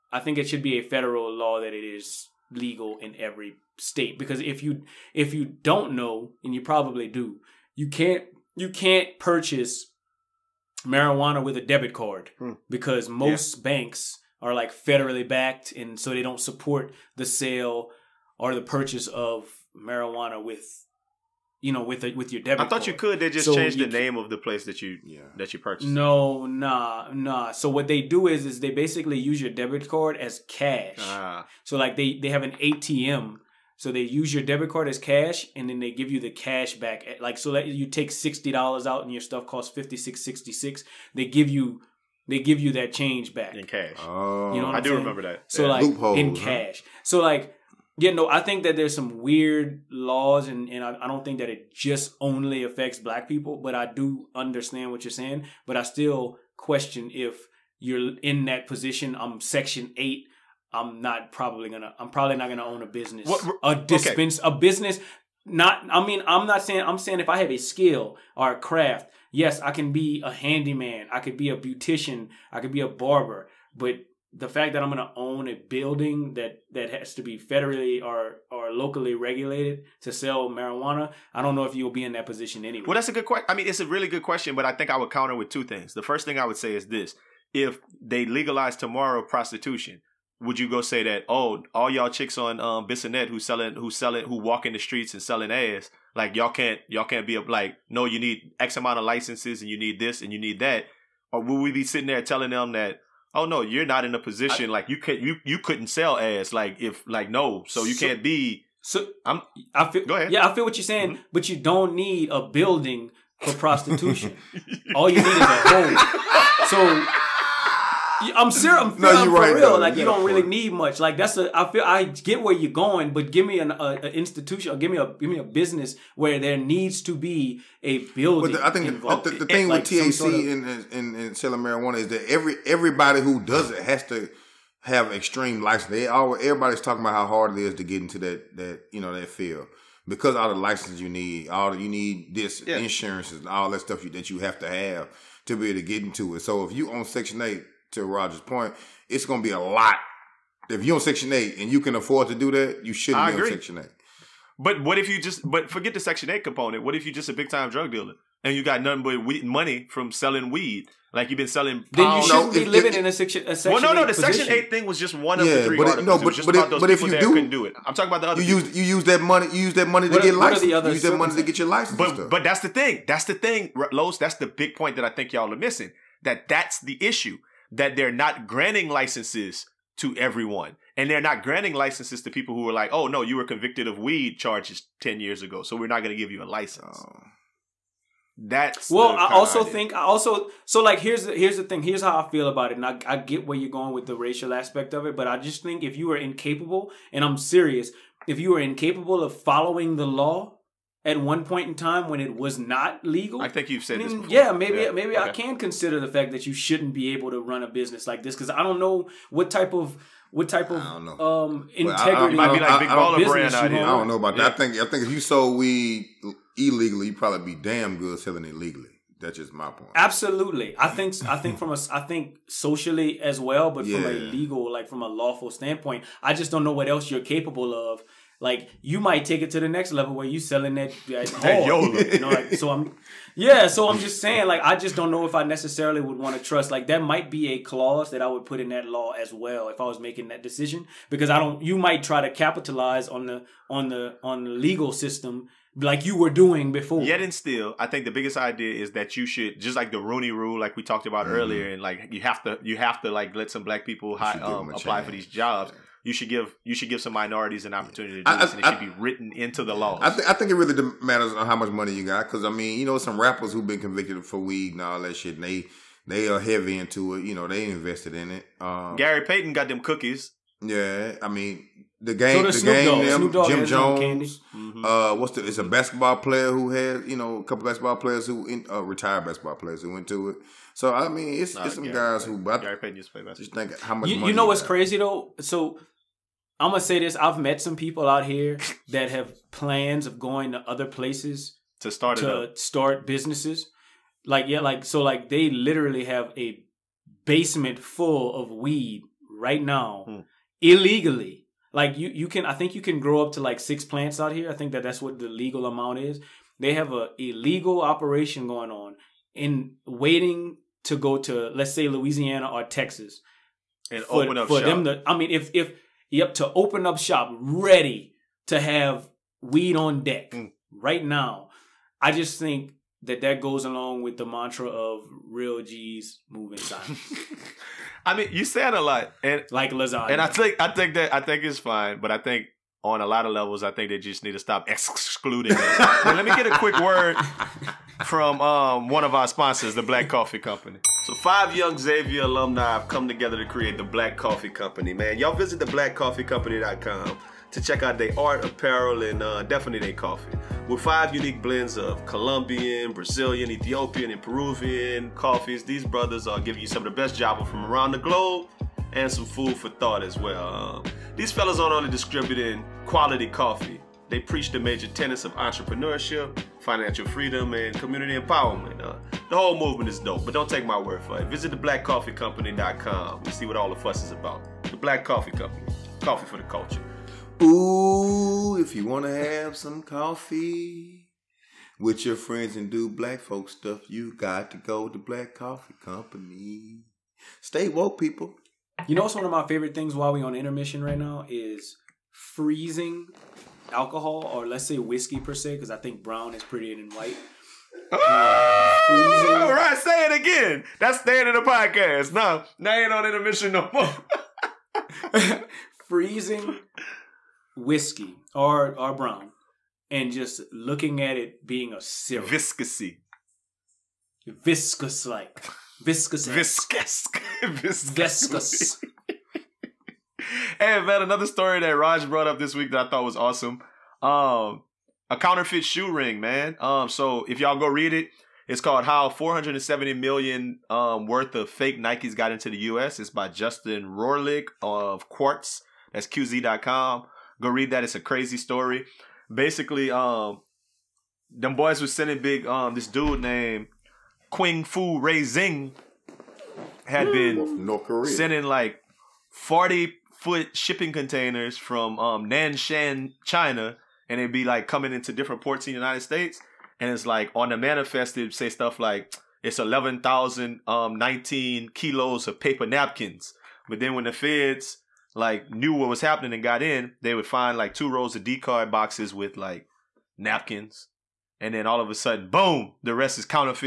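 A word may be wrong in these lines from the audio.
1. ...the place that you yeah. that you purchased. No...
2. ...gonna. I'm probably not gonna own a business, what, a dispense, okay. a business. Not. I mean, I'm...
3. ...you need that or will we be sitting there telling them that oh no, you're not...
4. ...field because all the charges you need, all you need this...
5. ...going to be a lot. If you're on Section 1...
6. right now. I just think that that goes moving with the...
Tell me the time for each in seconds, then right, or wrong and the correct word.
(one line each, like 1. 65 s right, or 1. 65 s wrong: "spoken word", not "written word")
1. 24 s right
2. 61 s right
3. 100 s right
4. 139 s wrong: "licenses", not "charges"
5. 149 s wrong: "8", not "1"
6. 320 s wrong: "along", not "moving".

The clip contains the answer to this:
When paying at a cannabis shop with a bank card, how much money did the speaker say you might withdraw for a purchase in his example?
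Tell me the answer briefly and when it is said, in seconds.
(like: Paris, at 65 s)
$60, at 38 s.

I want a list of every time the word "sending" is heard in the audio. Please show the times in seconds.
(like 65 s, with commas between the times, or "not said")
441 s, 448 s.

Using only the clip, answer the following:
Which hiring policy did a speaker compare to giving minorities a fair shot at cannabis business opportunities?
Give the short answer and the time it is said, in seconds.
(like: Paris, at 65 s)
Rooney Rule, at 250 s.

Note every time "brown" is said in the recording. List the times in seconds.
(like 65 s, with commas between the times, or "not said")
396 s, 408 s.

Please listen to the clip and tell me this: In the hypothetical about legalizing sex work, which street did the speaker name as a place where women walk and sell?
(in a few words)
Bissonette.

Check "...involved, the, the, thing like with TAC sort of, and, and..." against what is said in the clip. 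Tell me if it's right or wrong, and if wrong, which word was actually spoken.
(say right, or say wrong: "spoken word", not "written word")
right.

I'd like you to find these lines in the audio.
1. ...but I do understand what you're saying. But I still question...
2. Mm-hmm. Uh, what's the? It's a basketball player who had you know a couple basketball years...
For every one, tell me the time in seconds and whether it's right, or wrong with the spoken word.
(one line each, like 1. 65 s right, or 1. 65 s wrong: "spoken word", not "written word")
1. 53 s right
2. 274 s wrong: "players", not "years".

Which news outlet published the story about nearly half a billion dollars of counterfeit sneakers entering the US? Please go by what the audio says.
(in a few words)
Quartz.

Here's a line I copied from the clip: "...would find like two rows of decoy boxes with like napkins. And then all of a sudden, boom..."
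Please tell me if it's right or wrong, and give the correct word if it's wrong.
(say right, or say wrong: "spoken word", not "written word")
right.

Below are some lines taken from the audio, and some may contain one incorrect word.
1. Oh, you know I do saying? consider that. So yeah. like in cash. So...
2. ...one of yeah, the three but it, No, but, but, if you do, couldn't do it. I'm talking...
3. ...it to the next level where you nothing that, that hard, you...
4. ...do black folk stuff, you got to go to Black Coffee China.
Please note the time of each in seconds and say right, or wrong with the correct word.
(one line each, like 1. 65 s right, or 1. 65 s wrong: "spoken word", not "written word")
1. 43 s wrong: "remember", not "consider"
2. 165 s right
3. 229 s wrong: "selling", not "nothing"
4. 382 s wrong: "Company", not "China".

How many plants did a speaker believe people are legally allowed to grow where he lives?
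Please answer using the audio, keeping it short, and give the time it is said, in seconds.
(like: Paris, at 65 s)
6, at 303 s.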